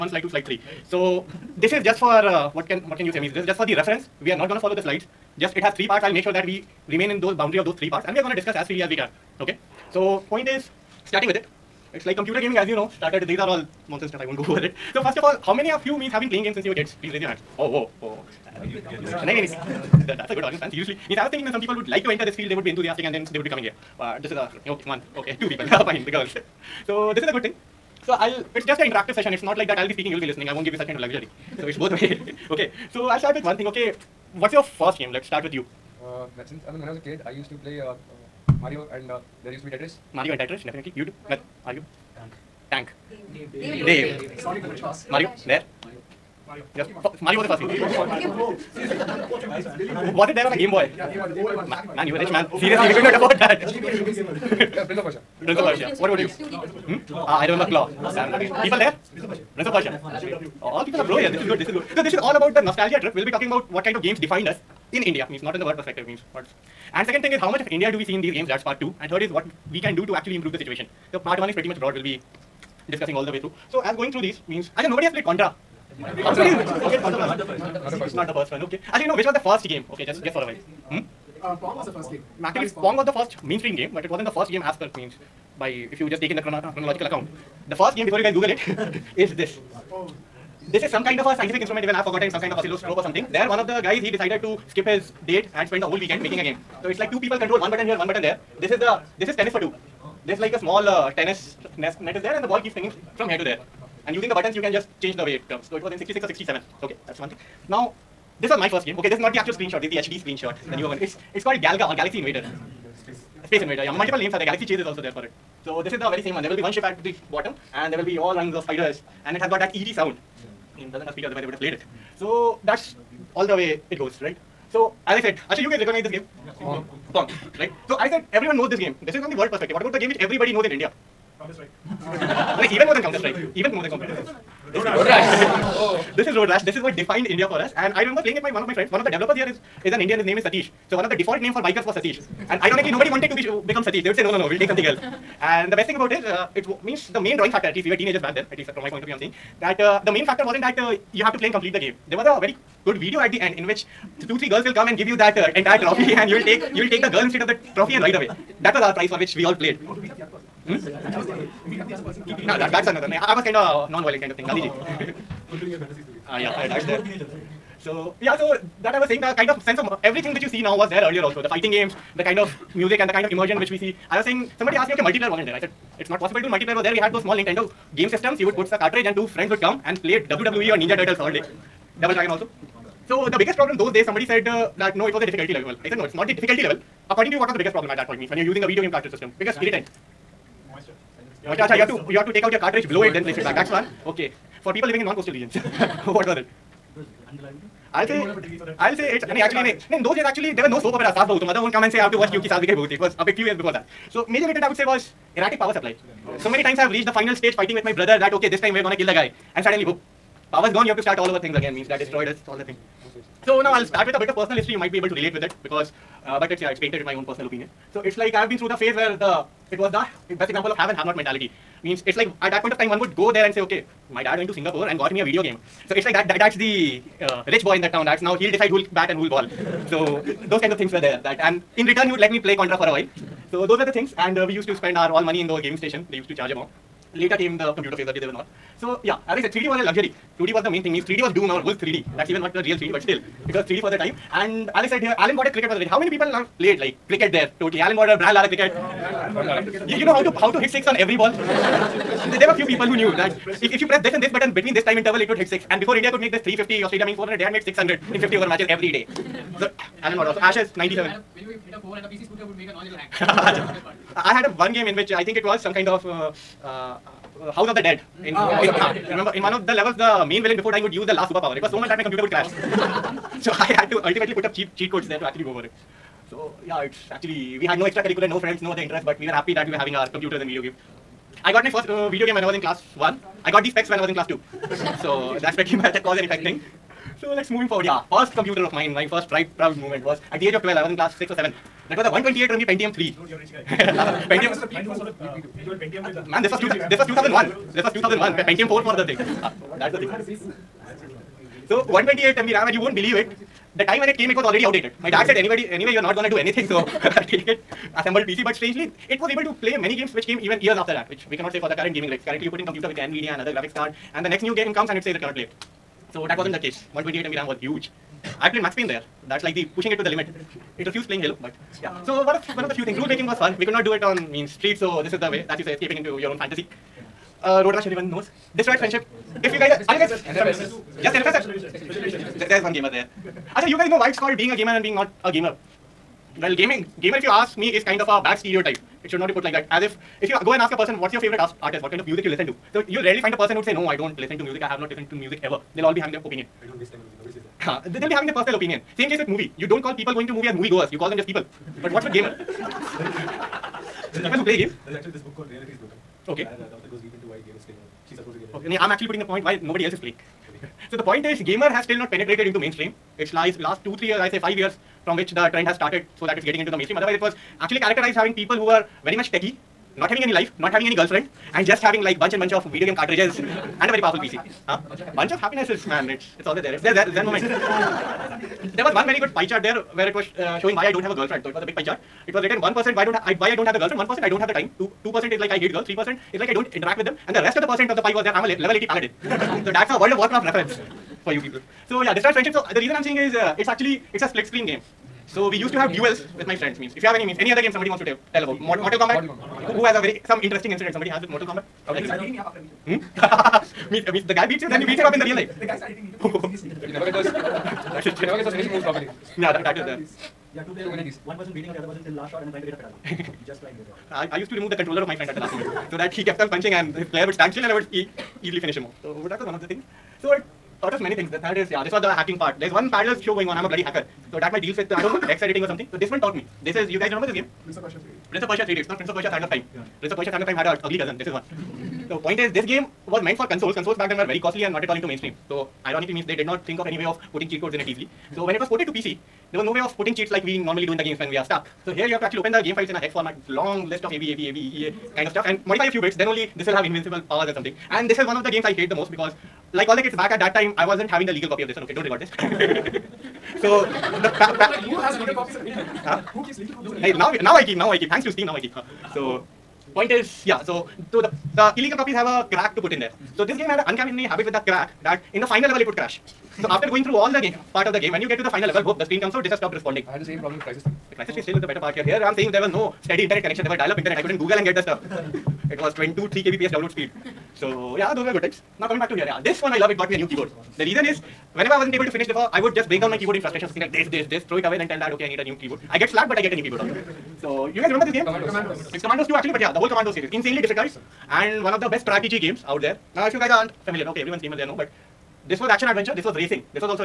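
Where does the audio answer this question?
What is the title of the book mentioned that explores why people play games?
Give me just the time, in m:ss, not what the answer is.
5:55.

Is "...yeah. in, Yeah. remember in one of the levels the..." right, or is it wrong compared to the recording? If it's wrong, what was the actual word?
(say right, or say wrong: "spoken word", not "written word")
right.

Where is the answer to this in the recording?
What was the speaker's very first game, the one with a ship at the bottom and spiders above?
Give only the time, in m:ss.
1:51.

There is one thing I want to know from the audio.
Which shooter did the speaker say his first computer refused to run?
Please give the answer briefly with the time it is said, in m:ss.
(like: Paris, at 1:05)
Halo, at 5:21.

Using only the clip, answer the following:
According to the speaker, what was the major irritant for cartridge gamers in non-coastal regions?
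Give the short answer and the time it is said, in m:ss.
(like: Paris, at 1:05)
Erratic power supply, at 3:25.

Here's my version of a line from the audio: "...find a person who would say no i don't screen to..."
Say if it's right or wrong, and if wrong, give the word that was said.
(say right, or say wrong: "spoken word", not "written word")
wrong: "listen", not "screen".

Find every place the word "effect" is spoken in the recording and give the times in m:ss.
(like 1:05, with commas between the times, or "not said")
4:46.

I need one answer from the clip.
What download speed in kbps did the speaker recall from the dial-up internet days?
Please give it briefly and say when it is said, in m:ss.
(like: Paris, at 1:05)
22-23 kbps, at 7:55.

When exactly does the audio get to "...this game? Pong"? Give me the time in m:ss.
2:06.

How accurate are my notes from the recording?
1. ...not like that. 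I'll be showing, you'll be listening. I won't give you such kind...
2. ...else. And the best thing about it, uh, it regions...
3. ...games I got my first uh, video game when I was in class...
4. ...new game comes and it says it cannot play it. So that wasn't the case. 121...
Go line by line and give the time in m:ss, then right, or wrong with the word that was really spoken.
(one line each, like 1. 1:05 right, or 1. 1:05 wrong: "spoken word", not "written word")
1. 0:29 wrong: "speaking", not "showing"
2. 2:24 wrong: "means", not "regions"
3. 4:40 right
4. 5:14 wrong: "128", not "121".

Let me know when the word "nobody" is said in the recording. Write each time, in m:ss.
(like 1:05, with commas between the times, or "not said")
1:14, 2:22, 5:47, 5:59.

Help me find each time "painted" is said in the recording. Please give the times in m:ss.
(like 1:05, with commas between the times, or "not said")
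3:36.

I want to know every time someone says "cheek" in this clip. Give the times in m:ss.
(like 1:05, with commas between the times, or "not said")
not said.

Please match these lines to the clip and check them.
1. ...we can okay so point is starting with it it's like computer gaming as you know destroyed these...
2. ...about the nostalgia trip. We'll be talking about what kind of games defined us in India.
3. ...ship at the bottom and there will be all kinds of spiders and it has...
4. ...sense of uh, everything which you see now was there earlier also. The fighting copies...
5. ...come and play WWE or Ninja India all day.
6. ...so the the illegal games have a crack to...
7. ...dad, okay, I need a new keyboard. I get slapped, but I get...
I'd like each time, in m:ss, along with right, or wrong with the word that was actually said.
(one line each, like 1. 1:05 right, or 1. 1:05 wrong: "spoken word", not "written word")
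1. 0:08 wrong: "started", not "destroyed"
2. 1:02 right
3. 1:56 right
4. 2:49 wrong: "games", not "copies"
5. 2:59 wrong: "Turtles", not "India"
6. 7:41 wrong: "copies", not "games"
7. 8:04 right.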